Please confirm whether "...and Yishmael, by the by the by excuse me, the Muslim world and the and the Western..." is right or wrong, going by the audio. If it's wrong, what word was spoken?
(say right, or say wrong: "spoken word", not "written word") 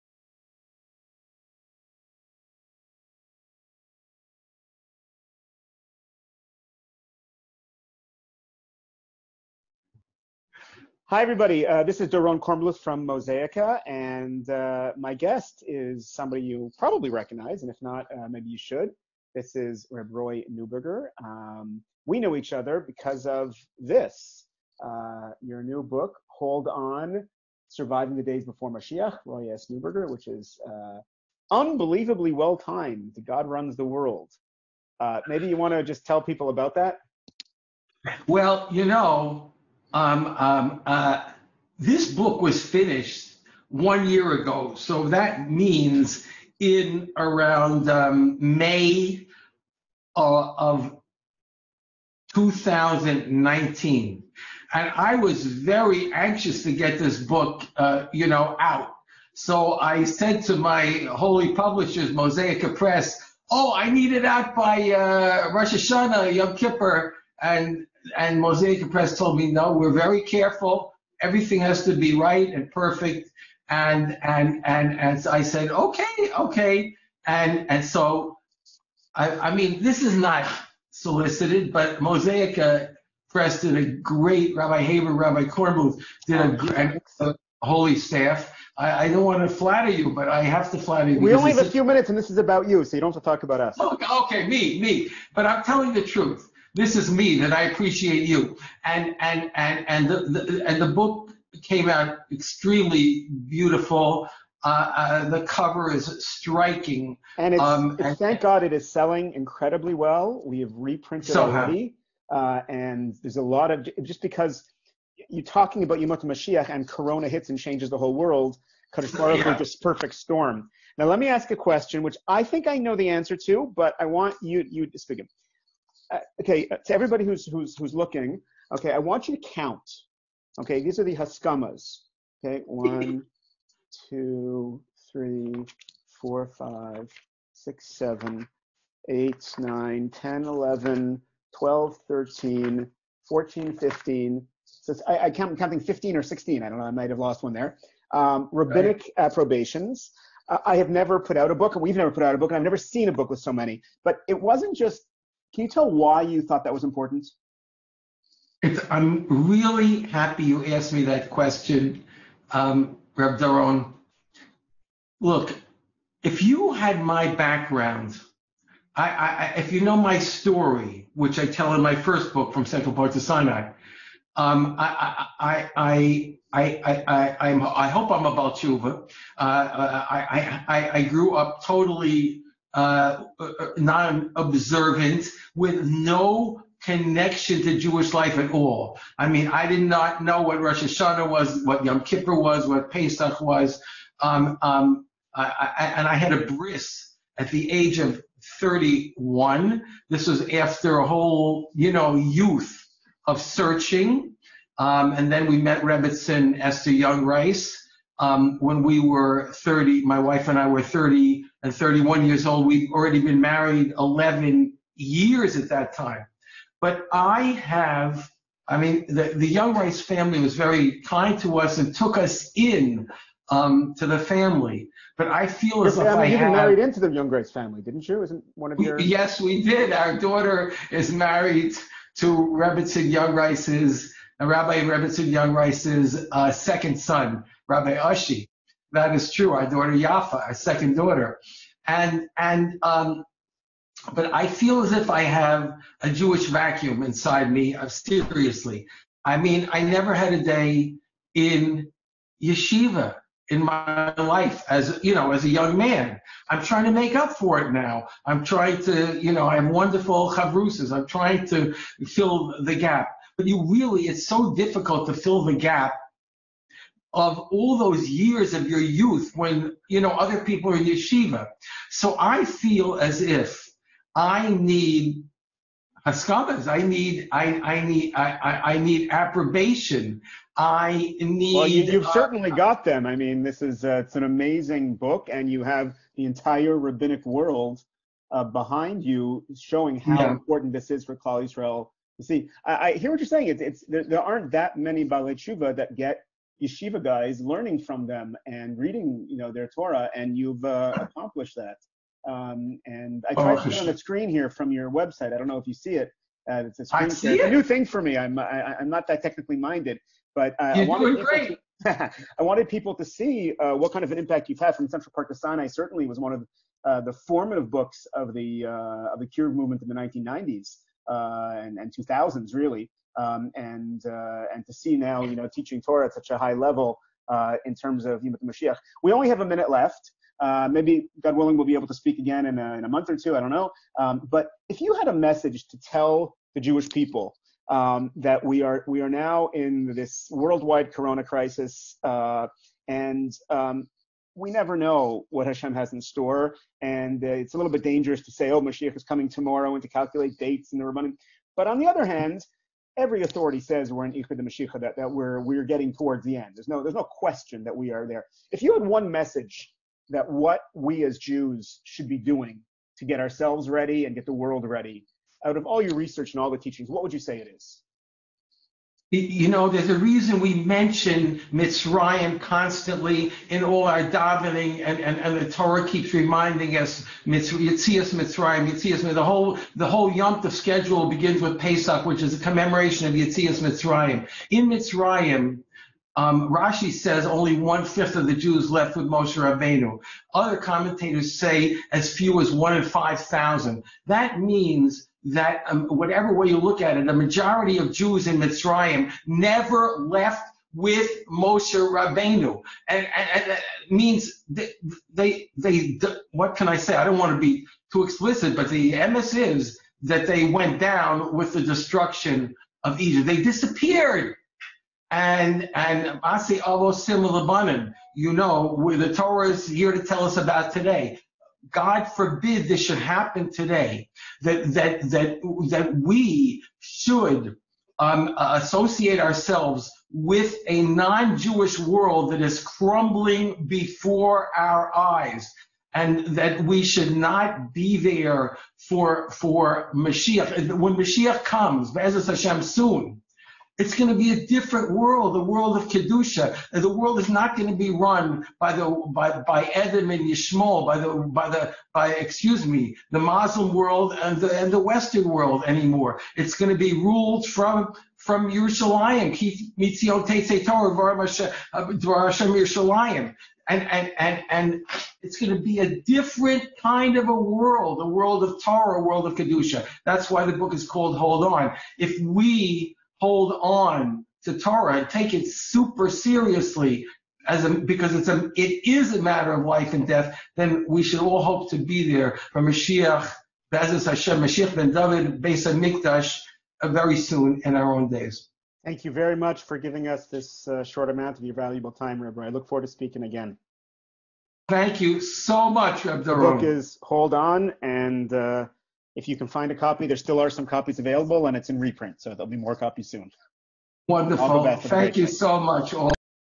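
right.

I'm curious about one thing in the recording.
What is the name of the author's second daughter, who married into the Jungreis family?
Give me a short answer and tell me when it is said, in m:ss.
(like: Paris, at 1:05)
Yafa, at 3:59.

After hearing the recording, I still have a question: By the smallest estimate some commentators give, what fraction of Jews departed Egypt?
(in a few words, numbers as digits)
5000.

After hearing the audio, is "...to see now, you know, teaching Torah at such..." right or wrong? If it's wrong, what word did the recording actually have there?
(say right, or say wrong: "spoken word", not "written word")
right.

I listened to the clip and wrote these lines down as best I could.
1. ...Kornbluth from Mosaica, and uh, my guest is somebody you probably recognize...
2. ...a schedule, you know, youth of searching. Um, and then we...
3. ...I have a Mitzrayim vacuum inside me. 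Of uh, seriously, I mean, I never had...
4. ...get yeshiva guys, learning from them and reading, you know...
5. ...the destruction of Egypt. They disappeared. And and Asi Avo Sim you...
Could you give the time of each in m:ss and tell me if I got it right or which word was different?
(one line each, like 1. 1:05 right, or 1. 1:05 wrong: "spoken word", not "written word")
1. 0:12 right
2. 3:20 wrong: "whole", not "schedule"
3. 4:05 wrong: "Jewish", not "Mitzrayim"
4. 4:55 right
5. 6:51 right.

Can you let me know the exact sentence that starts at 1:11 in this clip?
Everything has to be right and perfect.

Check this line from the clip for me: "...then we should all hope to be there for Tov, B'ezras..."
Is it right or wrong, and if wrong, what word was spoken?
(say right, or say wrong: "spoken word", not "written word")
wrong: "Mashiach", not "Tov".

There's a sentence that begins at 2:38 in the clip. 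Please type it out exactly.
It's, I'm really happy you asked me that question, um, Reb Doron.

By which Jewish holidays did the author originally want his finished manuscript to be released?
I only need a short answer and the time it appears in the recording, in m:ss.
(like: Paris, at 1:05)
Rosh Hashanah, Yom Kippur, at 1:05.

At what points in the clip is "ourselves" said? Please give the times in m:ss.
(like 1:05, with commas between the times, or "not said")
6:03, 7:09.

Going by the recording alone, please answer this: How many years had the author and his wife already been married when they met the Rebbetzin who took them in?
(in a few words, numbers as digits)
11.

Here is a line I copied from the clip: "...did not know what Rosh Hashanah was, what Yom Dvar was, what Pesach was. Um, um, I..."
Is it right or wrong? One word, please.
wrong.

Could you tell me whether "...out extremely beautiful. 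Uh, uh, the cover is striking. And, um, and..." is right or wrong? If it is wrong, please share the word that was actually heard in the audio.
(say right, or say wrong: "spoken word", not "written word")
right.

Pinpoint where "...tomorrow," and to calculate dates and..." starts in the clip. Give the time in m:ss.
5:49.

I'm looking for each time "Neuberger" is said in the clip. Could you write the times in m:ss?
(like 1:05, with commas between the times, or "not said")
0:20, 0:29.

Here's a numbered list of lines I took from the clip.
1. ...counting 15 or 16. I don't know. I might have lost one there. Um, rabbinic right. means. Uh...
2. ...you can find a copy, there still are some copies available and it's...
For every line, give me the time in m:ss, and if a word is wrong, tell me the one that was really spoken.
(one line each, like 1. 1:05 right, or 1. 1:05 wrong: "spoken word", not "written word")
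1. 2:25 wrong: "approbations", not "means"
2. 8:19 right.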